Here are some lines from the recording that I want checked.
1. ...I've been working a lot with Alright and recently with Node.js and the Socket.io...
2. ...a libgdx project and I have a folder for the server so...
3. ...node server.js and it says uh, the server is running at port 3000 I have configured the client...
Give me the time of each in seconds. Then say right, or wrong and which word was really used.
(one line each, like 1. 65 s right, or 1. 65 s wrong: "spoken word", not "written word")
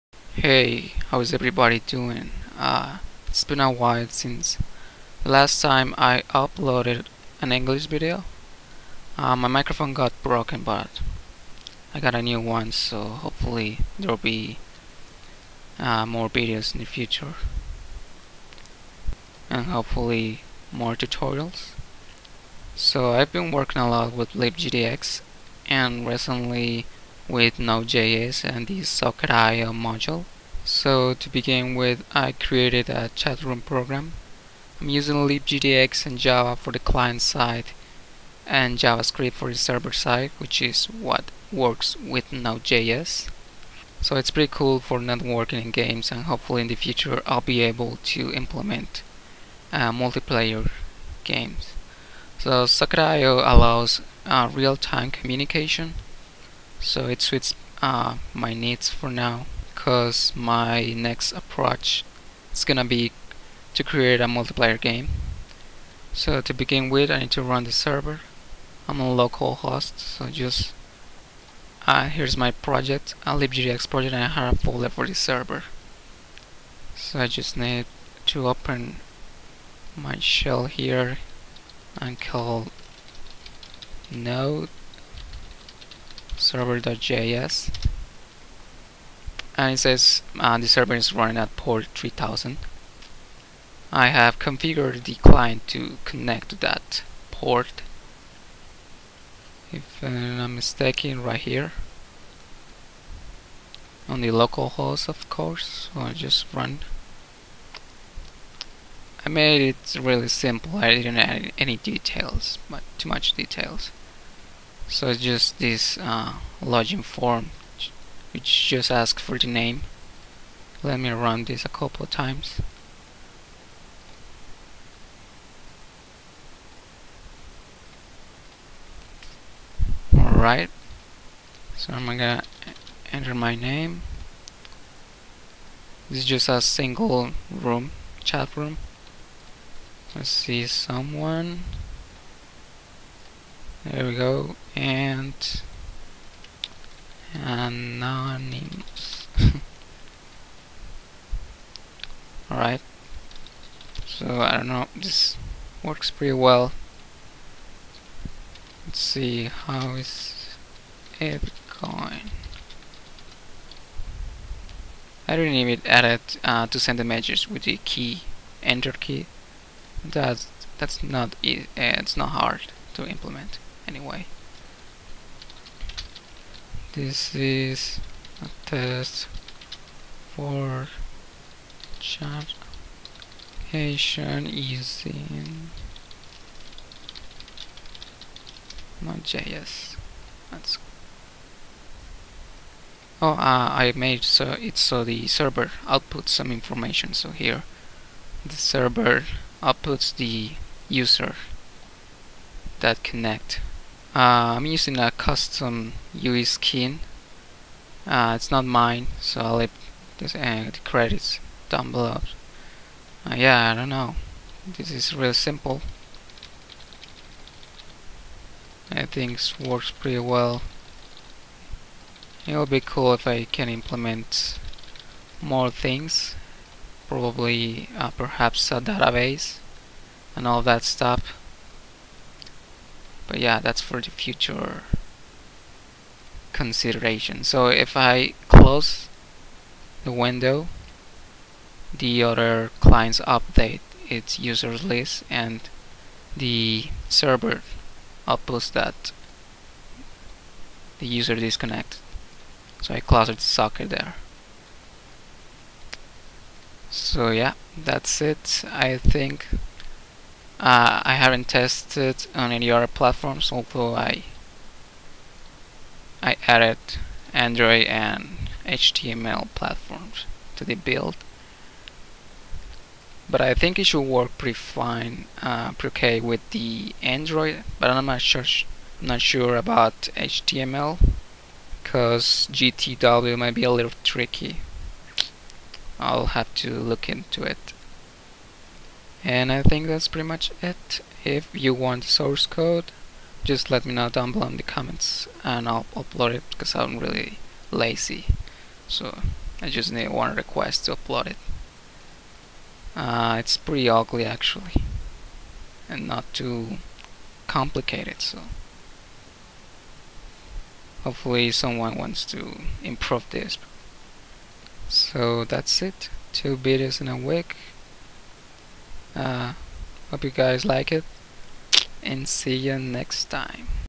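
1. 23 s wrong: "LibGDX", not "Alright"
2. 73 s right
3. 84 s right.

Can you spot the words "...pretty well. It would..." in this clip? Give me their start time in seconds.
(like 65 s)
219 s.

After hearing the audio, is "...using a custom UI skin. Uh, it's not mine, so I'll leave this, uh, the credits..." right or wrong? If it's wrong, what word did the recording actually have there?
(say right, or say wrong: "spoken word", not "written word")
right.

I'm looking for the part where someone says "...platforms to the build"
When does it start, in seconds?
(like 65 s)
269 s.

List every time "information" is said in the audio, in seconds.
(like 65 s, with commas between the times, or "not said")
196 s.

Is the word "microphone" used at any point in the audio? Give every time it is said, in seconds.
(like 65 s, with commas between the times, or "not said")
9 s.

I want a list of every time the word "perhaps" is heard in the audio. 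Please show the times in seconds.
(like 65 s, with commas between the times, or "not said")
228 s.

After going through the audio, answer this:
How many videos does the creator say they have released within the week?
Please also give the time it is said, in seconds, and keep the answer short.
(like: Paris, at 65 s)
2, at 316 s.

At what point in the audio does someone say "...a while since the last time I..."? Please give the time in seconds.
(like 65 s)
3 s.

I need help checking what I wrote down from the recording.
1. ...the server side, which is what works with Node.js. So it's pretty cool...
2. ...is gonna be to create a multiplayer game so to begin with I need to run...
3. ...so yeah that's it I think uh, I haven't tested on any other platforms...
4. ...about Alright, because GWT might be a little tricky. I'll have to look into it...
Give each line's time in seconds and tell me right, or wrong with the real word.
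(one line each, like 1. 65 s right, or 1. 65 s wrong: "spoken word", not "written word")
1. 39 s right
2. 62 s right
3. 256 s right
4. 279 s wrong: "HTML", not "Alright".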